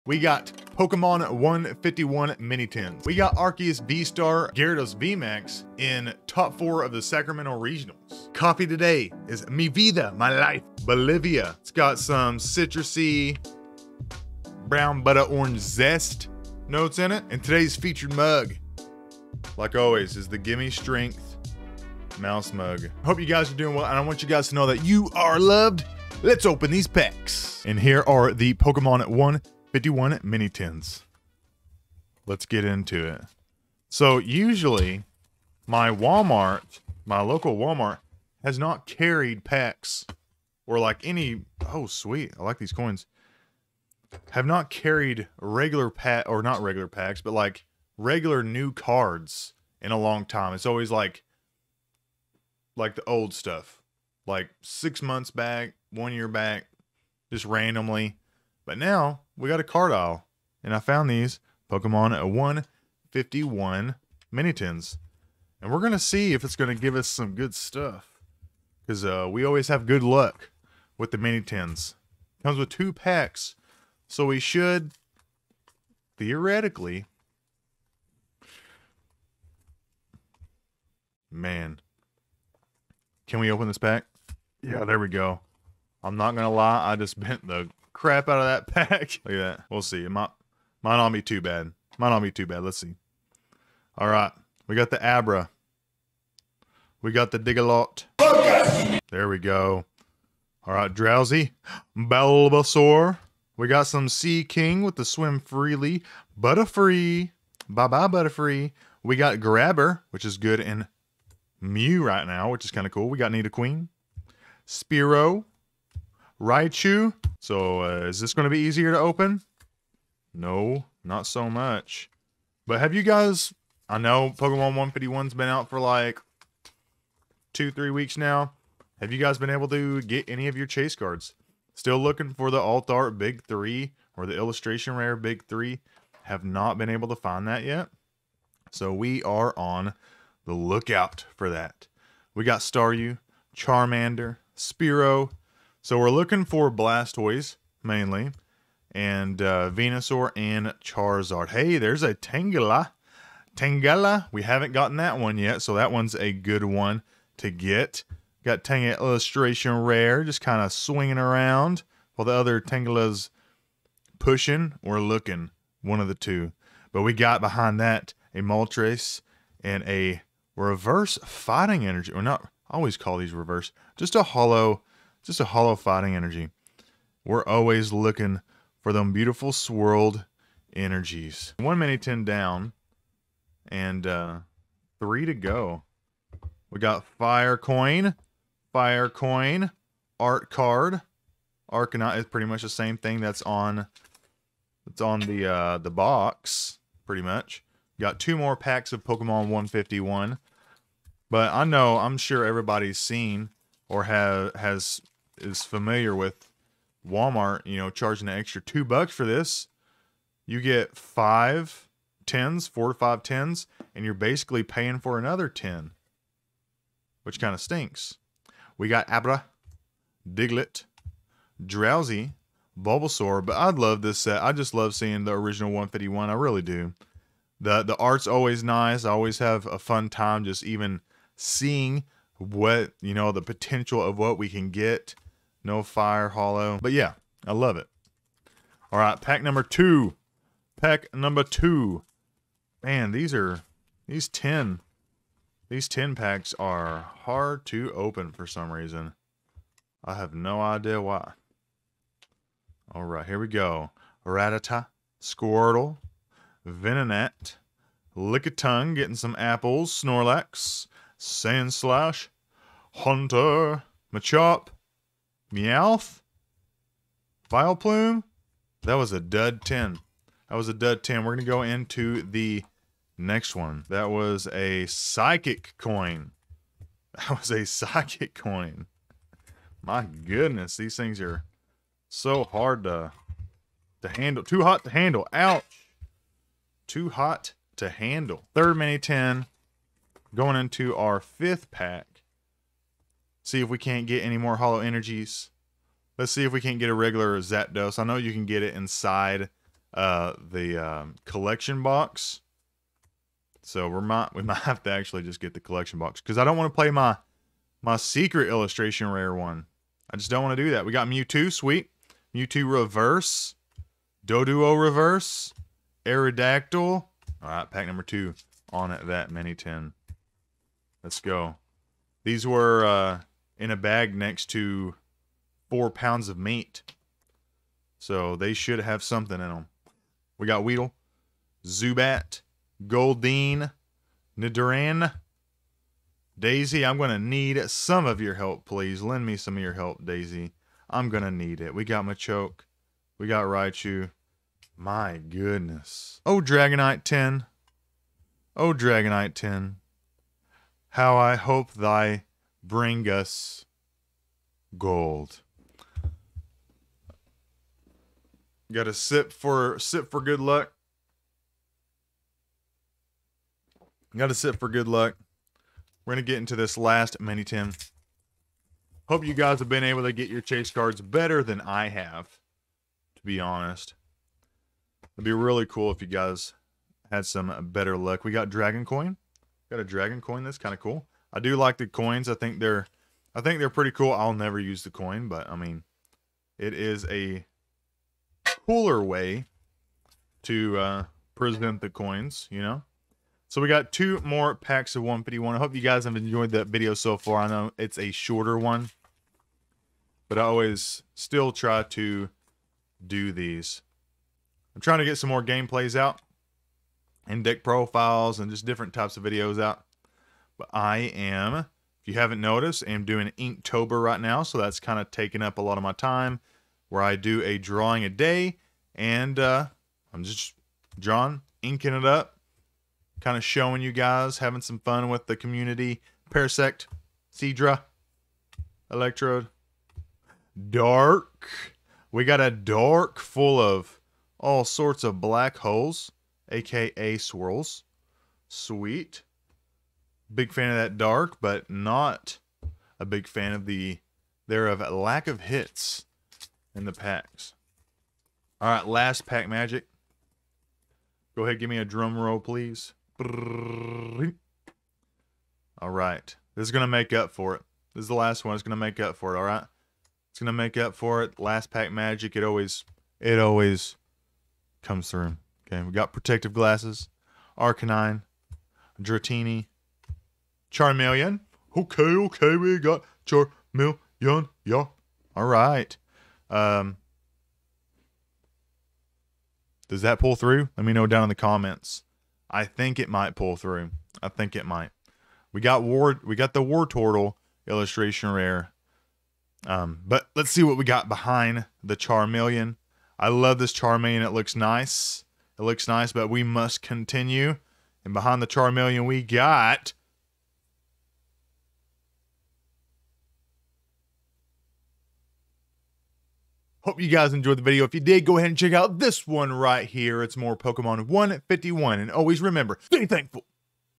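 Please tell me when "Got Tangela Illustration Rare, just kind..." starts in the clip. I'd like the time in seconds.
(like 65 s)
158 s.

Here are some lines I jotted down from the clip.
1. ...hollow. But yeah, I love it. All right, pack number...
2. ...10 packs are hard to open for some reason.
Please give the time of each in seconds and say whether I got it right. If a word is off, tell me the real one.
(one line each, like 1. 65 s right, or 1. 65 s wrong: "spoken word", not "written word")
1. 236 s right
2. 245 s right.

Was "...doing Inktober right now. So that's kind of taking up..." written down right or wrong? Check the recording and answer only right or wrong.
right.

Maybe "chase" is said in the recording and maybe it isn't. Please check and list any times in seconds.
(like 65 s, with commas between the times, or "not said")
130 s, 370 s.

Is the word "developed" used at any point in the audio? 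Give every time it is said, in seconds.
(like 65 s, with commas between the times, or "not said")
not said.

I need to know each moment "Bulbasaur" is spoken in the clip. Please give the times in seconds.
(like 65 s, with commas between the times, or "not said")
101 s, 222 s.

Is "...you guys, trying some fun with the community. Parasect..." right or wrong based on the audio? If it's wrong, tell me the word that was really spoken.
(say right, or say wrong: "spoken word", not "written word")
wrong: "having", not "trying".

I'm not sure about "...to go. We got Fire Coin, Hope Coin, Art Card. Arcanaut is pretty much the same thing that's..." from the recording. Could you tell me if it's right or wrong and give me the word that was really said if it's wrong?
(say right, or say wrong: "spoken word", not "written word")
wrong: "Fire", not "Hope".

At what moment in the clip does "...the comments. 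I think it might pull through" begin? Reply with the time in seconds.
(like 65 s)
481 s.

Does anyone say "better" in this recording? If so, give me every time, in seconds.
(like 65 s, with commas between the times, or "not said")
371 s, 377 s.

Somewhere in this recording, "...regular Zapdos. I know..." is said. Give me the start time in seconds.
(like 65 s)
296 s.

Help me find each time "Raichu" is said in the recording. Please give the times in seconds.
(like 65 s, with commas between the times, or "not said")
116 s, 343 s.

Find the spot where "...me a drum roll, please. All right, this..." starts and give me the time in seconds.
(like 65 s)
451 s.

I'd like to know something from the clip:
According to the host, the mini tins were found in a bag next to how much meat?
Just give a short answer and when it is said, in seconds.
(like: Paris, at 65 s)
4 pounds, at 325 s.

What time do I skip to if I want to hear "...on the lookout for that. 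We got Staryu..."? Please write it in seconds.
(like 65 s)
139 s.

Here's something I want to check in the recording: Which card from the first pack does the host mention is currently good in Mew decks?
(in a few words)
Grabber.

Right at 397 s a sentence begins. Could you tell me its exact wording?
I know it's a shorter one, but I always still try to do these.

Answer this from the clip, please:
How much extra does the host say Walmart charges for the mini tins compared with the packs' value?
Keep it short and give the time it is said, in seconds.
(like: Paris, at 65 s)
2 bucks, at 208 s.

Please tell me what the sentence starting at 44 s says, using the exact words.
Have not carried regular pack or not regular packs, but like regular new cards in a long time.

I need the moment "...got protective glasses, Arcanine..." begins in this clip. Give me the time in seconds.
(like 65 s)
465 s.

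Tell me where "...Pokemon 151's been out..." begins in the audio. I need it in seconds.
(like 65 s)
124 s.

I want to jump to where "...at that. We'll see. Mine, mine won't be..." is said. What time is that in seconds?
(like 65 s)
89 s.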